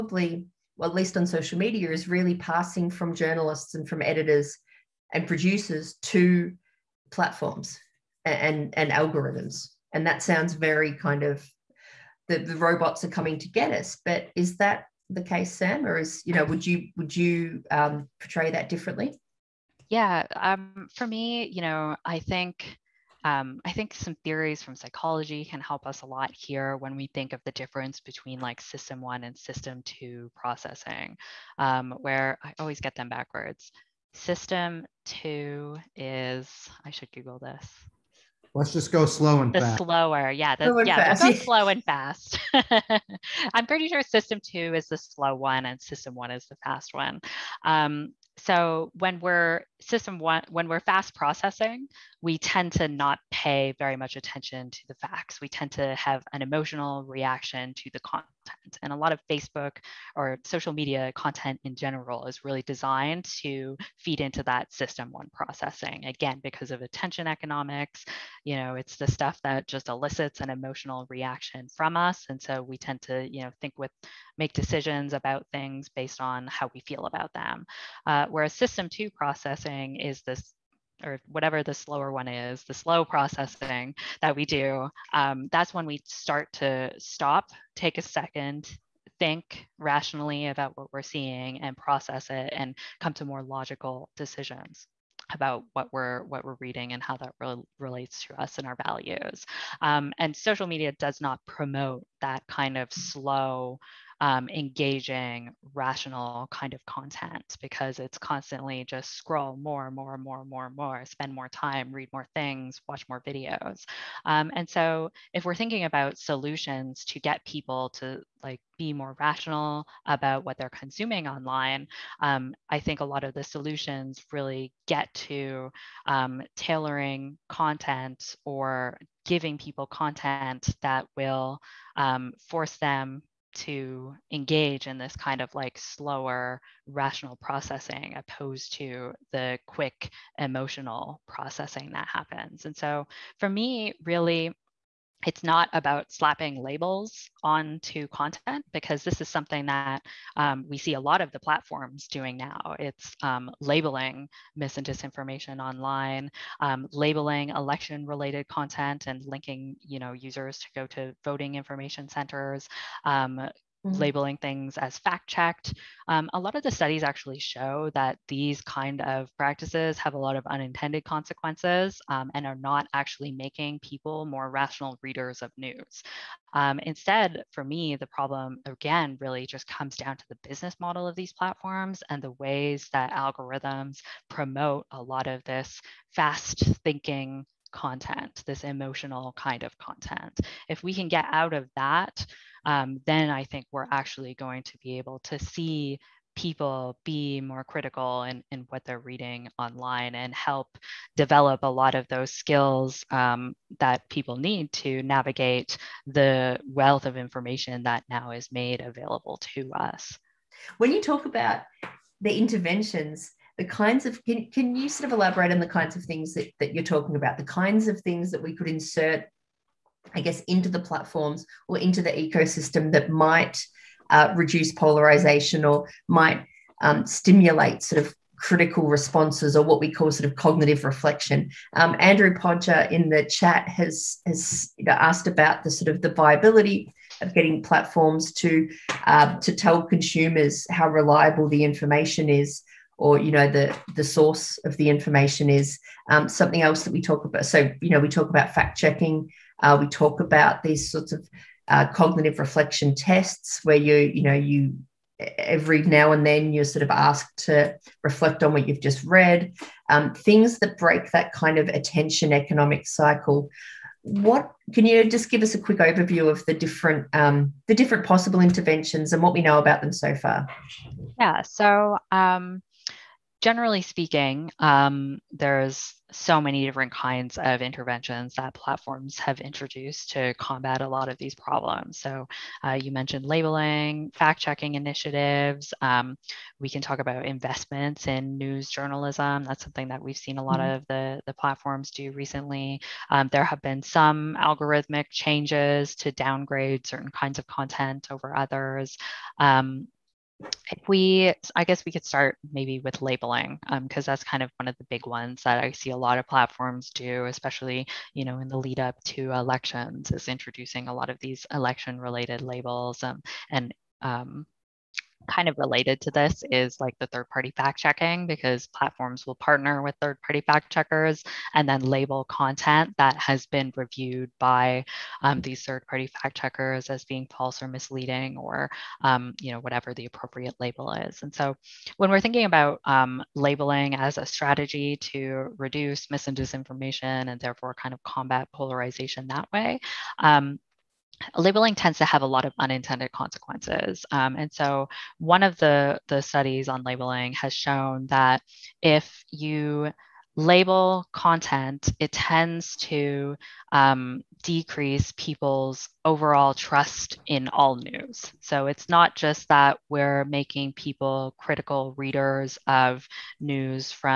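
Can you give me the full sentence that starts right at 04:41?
So uh, you mentioned labeling, fact checking initiatives.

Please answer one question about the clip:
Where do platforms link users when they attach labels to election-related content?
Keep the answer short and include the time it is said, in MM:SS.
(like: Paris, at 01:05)
Voting information centers, at 02:41.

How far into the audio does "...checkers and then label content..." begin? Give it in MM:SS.
05:20.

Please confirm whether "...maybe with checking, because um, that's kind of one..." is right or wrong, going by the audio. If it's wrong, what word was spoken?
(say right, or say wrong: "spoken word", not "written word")
wrong: "labeling", not "checking".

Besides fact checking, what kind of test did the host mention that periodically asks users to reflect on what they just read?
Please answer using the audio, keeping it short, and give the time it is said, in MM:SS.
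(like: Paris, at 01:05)
Cognitive reflection tests, at 04:11.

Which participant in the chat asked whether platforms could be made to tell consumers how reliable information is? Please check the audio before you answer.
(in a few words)
Andrew Podger.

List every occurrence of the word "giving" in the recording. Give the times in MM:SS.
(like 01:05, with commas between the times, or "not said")
02:09.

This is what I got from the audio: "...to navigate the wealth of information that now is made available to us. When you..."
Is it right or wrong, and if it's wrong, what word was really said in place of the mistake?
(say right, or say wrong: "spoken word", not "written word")
right.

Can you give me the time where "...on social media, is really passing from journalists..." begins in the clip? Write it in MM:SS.
00:01.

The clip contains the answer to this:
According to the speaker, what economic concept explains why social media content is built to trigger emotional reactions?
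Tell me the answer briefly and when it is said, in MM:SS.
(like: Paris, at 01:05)
Attention economics, at 01:06.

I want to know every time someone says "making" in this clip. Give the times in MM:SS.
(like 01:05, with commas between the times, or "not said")
02:53, 06:00.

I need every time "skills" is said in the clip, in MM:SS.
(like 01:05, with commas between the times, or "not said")
03:22.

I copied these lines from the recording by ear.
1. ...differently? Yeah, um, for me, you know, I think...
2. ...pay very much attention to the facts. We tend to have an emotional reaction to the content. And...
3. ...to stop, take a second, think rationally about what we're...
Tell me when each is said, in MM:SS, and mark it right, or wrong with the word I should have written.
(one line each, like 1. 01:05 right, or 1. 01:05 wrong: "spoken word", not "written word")
1. 00:18 right
2. 00:53 right
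3. 01:26 right.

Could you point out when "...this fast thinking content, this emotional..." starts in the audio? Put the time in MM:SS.
03:05.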